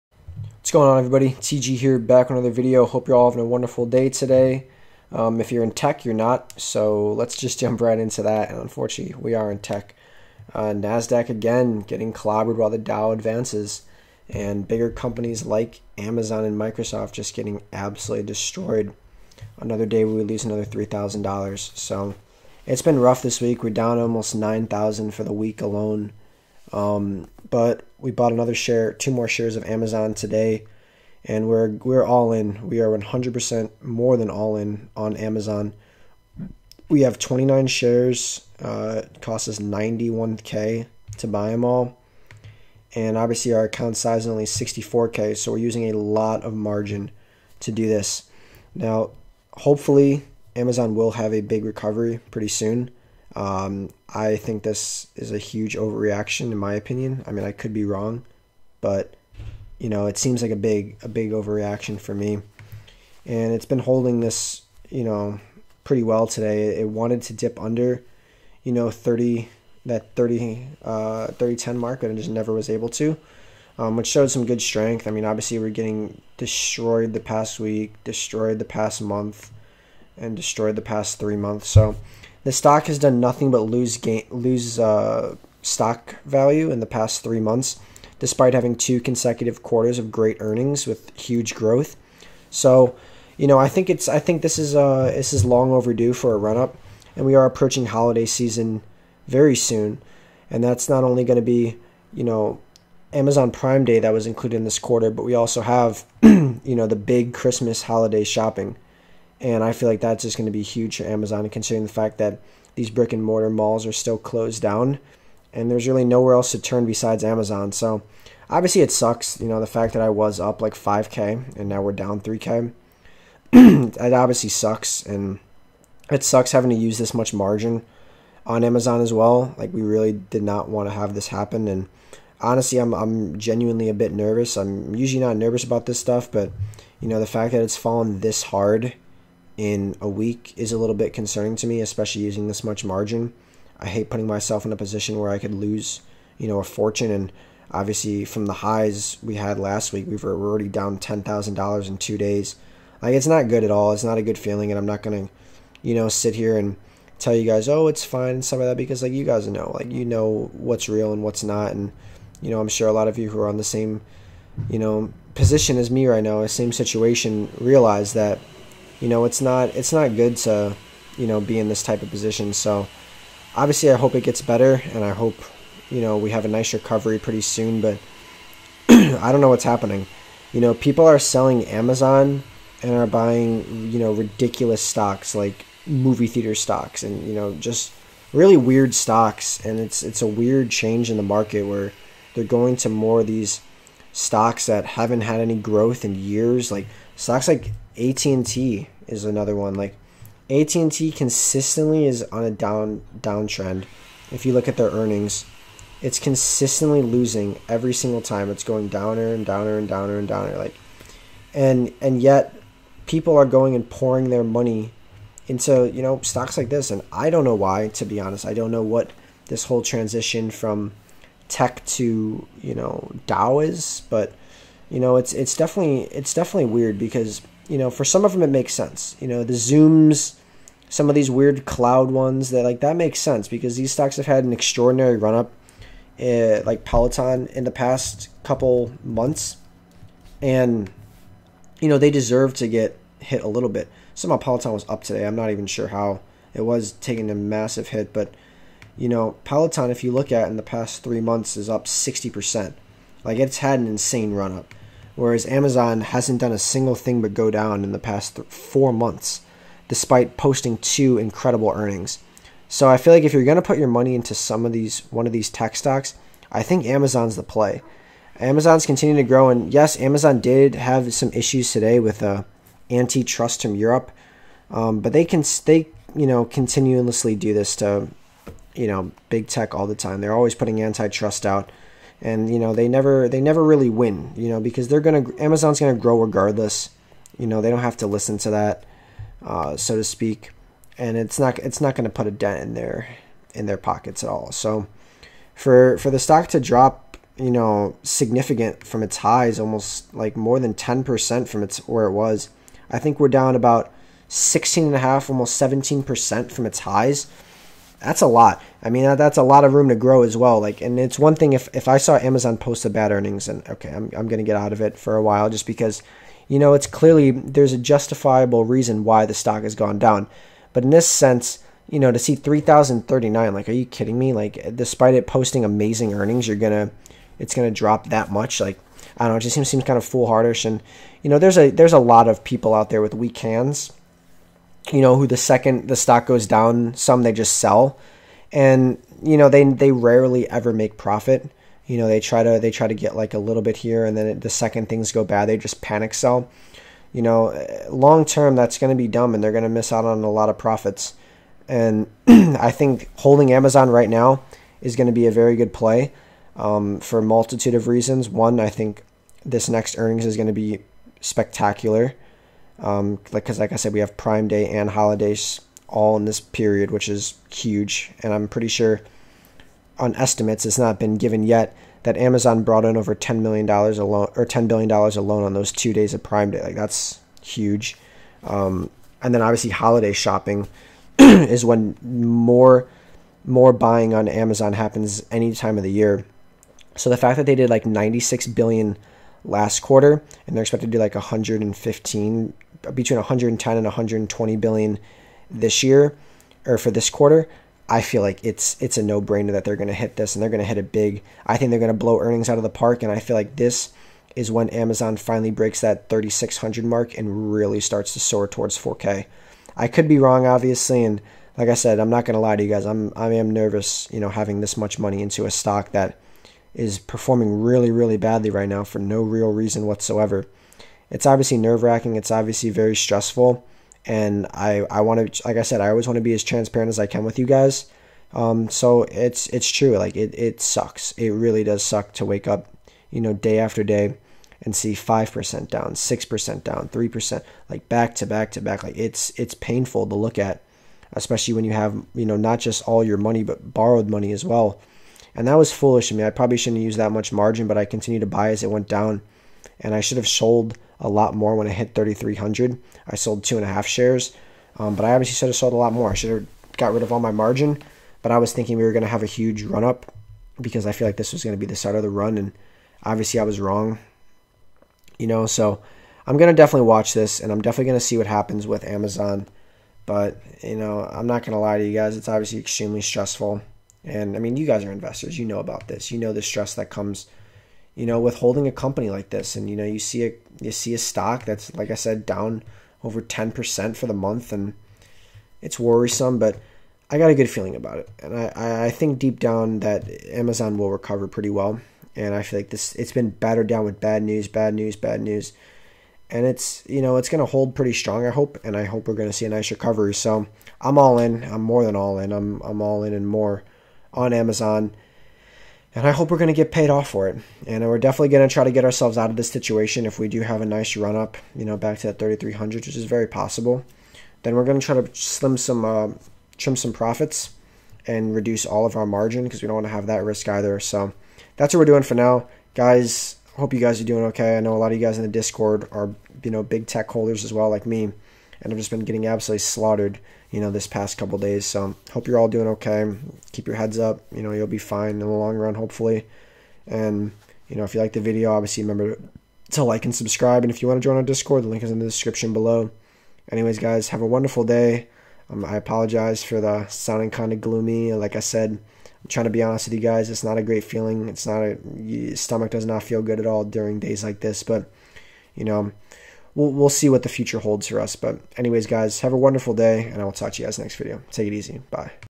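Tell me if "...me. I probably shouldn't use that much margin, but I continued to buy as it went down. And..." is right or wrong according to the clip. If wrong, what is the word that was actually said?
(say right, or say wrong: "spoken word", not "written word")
right.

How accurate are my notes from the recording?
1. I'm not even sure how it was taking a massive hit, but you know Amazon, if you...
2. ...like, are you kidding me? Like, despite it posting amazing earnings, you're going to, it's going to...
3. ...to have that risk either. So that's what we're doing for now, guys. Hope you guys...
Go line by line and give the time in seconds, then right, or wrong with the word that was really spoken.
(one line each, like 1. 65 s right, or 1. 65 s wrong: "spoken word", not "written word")
1. 245 s wrong: "Peloton", not "Amazon"
2. 323 s right
3. 519 s right.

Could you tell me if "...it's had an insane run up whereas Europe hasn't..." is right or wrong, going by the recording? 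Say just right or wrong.
wrong.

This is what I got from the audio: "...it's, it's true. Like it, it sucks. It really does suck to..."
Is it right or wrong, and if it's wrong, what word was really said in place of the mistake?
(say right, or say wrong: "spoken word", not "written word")
right.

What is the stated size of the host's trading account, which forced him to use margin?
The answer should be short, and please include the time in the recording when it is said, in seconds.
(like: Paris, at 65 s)
64k, at 44 s.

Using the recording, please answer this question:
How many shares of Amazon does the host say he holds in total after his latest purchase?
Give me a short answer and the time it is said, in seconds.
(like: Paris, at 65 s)
29, at 37 s.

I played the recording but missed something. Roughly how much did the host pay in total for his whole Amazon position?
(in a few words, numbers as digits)
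91k.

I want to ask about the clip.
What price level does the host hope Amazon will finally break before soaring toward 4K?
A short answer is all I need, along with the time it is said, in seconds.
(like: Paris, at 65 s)
3600, at 406 s.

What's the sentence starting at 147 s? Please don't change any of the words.
And obviously, from the highs we had last week, we were already down ten thousand dollars in two days.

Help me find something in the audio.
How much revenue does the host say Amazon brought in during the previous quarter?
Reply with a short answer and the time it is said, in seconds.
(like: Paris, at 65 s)
96 billion, at 387 s.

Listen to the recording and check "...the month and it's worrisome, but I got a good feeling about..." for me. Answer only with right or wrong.
right.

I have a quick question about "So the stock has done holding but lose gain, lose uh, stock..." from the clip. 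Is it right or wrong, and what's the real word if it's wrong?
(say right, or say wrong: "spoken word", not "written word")
wrong: "nothing", not "holding".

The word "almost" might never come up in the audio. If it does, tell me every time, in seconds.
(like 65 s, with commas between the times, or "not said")
23 s, 299 s, 305 s.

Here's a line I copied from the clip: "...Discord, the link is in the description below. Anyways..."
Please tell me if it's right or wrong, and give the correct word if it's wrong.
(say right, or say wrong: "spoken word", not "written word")
right.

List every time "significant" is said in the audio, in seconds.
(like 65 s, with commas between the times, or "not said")
298 s.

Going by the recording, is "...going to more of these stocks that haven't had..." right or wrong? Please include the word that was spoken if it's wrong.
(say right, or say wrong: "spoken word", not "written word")
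right.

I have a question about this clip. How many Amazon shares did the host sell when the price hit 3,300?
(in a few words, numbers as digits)
2.5.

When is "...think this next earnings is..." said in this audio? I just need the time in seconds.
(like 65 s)
358 s.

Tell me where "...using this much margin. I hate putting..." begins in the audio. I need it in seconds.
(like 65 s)
142 s.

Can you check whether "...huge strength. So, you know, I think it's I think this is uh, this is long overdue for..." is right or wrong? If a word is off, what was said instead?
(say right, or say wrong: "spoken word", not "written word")
wrong: "growth", not "strength".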